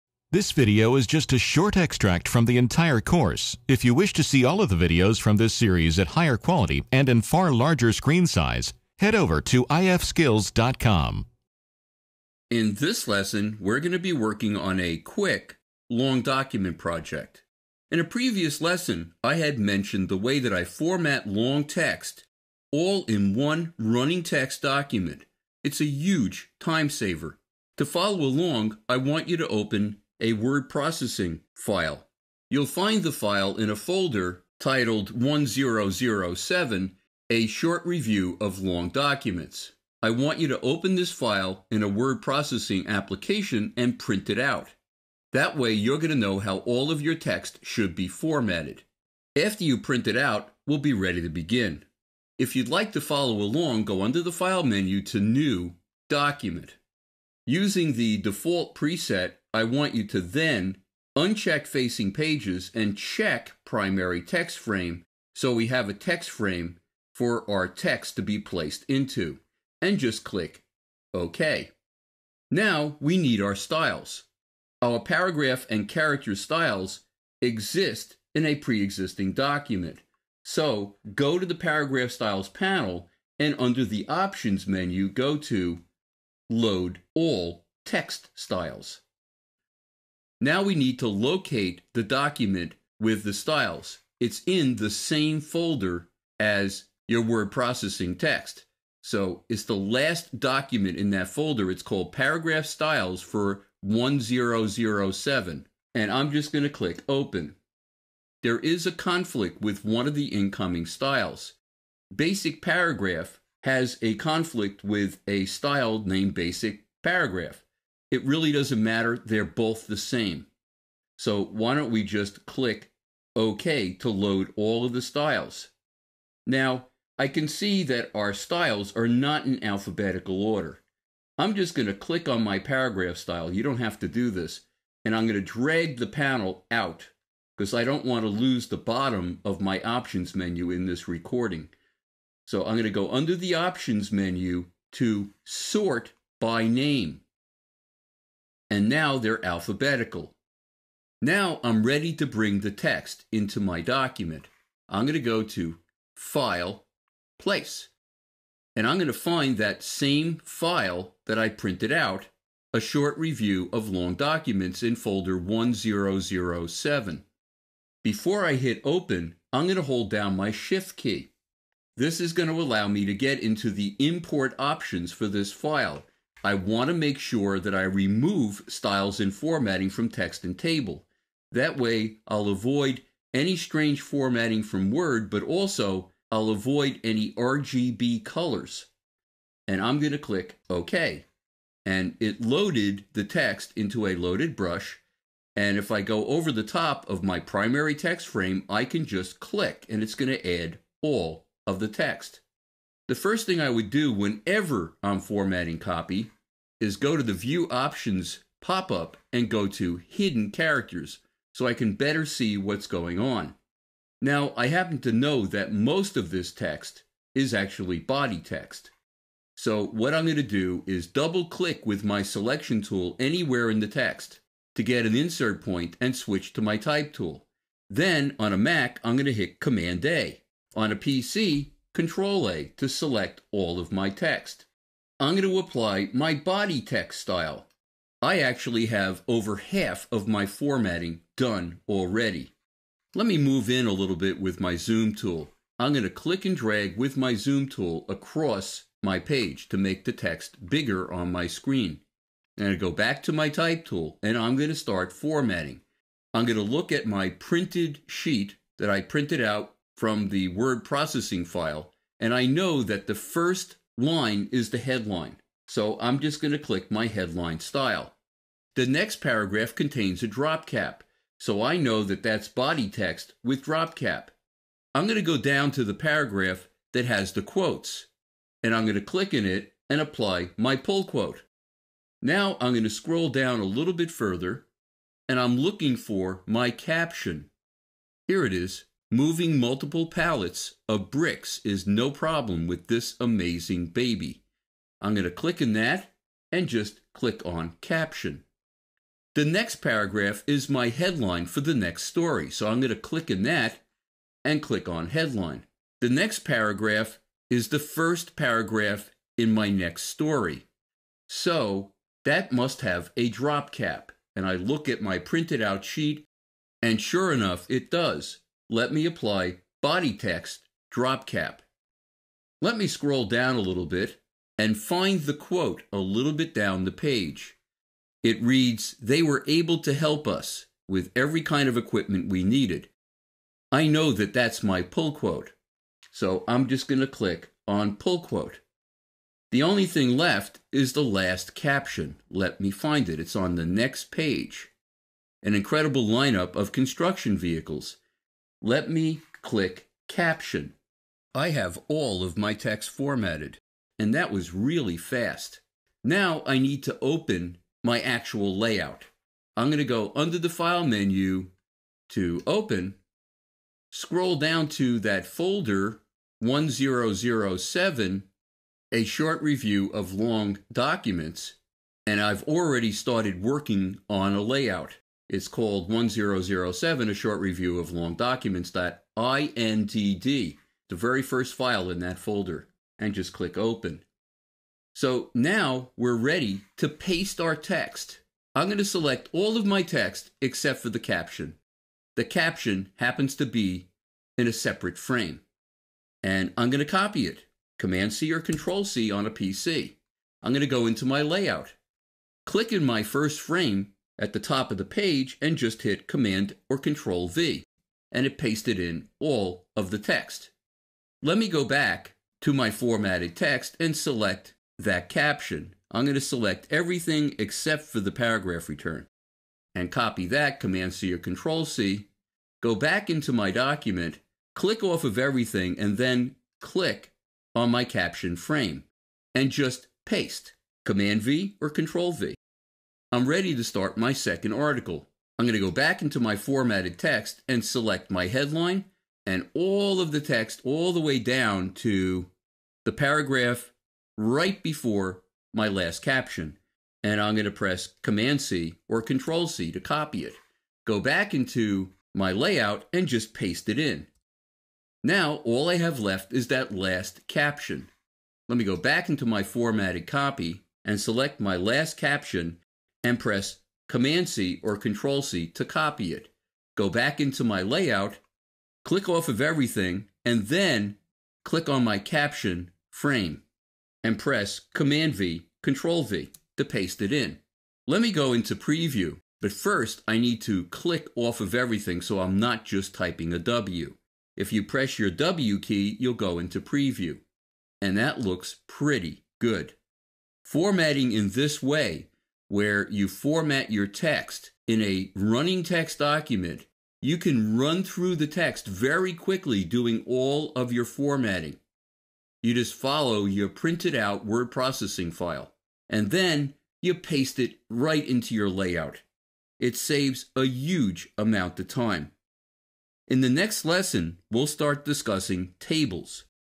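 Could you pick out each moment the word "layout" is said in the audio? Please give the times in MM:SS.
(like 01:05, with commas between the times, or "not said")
05:58, 06:14, 06:41, 07:32, 07:47, 08:28.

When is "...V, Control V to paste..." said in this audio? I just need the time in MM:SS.
07:55.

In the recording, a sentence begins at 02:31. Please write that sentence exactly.
Now I'm ready to bring the text into my document.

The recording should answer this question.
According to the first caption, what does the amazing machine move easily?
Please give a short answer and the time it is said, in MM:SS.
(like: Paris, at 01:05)
multiple pallets of bricks, at 04:49.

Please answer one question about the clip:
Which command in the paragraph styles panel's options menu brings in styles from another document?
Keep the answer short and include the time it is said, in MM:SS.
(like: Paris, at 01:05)
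load all text styles, at 01:26.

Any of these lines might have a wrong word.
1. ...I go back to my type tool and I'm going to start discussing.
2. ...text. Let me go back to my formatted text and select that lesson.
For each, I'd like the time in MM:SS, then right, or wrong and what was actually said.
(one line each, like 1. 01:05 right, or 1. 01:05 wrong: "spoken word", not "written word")
1. 04:12 wrong: "formatting", not "discussing"
2. 06:49 wrong: "caption", not "lesson".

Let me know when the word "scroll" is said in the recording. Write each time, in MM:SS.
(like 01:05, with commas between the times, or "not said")
04:42, 05:22, 06:03.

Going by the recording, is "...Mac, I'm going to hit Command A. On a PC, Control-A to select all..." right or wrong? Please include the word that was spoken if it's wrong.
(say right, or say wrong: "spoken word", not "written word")
right.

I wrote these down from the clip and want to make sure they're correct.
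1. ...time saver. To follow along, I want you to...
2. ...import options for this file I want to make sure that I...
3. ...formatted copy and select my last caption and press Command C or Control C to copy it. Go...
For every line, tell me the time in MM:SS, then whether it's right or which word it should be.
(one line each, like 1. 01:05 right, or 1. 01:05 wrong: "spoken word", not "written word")
1. 00:26 right
2. 02:53 right
3. 07:39 right.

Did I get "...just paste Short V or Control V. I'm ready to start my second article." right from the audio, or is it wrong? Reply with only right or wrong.
wrong.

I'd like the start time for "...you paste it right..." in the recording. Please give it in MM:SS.
08:26.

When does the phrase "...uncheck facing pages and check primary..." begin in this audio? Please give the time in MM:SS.
01:01.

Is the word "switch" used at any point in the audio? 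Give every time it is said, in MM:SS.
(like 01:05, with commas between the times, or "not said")
03:46.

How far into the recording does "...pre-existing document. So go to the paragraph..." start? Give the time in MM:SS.
01:18.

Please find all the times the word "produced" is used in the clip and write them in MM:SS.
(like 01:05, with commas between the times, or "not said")
not said.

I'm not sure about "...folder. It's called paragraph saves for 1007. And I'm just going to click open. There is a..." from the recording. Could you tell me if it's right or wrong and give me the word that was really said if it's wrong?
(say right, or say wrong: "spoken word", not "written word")
wrong: "styles", not "saves".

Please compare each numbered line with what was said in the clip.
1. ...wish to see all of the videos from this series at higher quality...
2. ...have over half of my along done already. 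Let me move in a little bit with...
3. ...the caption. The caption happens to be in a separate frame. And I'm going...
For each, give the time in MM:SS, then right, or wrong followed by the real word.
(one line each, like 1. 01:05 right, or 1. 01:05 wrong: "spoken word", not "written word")
1. 00:03 right
2. 03:58 wrong: "formatting", not "along"
3. 06:30 right.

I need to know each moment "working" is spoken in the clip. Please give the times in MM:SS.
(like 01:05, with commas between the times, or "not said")
00:14, 06:13.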